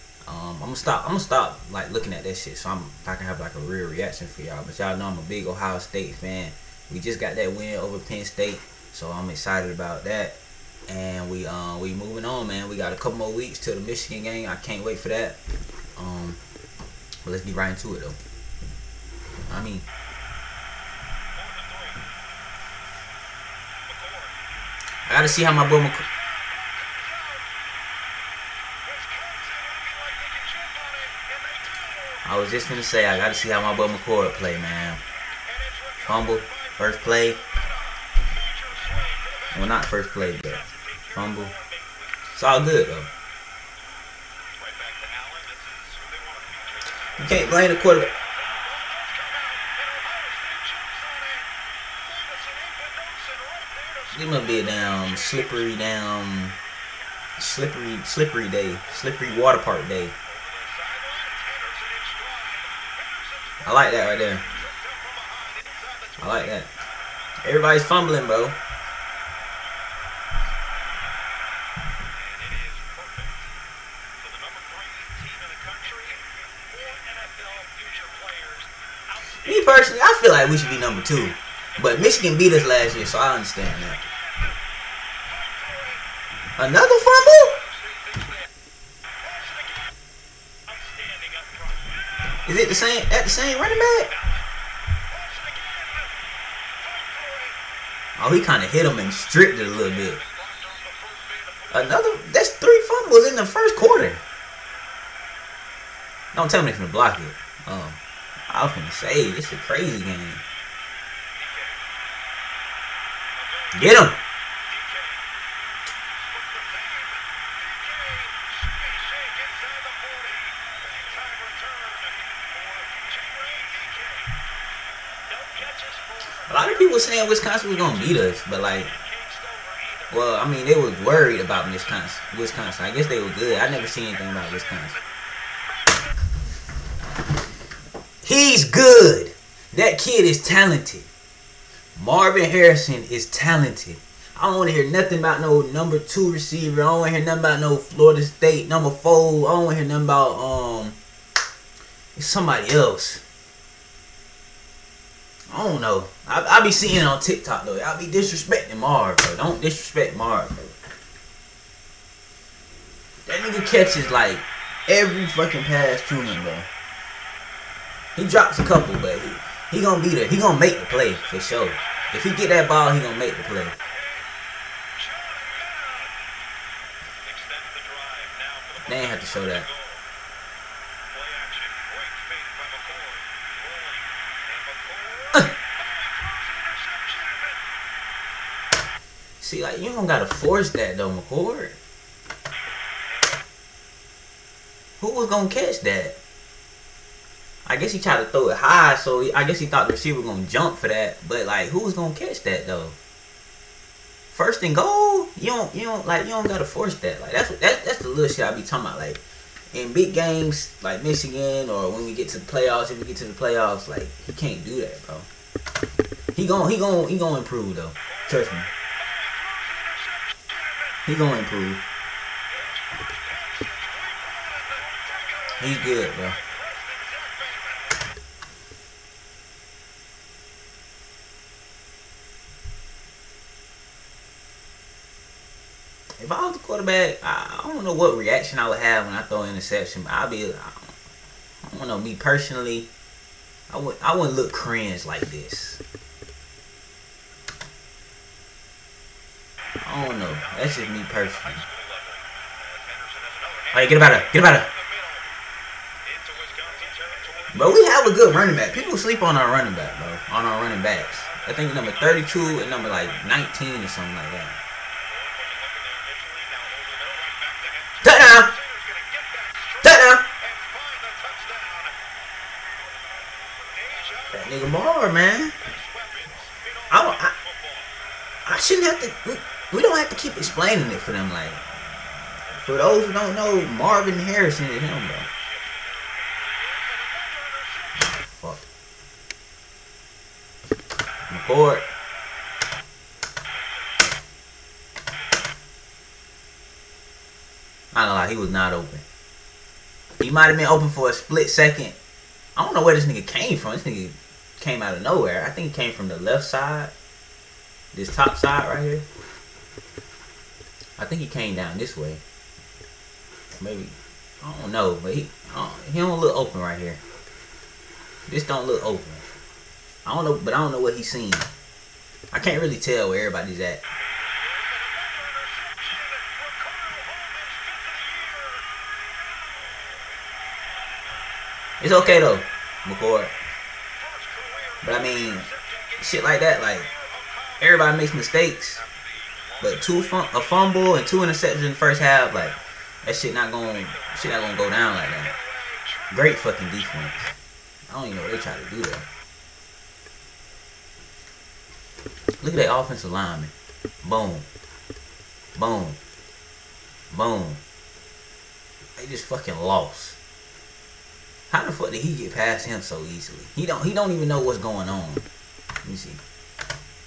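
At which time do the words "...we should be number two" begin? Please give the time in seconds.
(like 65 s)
80 s.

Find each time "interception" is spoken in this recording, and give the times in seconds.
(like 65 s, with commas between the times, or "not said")
239 s, 341 s.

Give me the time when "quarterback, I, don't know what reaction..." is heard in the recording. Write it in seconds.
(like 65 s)
236 s.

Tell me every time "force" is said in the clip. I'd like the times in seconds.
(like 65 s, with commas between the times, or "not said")
190 s, 206 s.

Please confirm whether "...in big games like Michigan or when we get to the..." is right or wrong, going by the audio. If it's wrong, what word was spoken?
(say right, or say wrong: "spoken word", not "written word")
right.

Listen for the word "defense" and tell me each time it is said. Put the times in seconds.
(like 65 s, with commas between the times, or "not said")
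346 s.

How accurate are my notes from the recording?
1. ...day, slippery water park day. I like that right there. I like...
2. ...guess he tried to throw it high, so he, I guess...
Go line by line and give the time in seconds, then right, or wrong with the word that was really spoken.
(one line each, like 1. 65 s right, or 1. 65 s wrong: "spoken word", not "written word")
1. 58 s right
2. 197 s right.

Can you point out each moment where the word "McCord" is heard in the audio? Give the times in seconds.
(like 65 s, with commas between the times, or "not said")
33 s, 191 s, 332 s.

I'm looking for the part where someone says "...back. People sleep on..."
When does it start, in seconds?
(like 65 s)
258 s.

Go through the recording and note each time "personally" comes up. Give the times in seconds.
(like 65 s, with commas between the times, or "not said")
79 s, 242 s, 251 s.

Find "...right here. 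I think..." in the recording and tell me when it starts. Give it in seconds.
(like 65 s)
308 s.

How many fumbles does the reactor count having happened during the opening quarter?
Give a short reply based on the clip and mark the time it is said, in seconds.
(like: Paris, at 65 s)
3, at 102 s.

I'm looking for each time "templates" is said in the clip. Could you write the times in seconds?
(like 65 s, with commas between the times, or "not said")
not said.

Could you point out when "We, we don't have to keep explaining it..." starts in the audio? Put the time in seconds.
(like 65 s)
279 s.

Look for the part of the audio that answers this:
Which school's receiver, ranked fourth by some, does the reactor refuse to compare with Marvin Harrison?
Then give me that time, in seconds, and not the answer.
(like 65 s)
147 s.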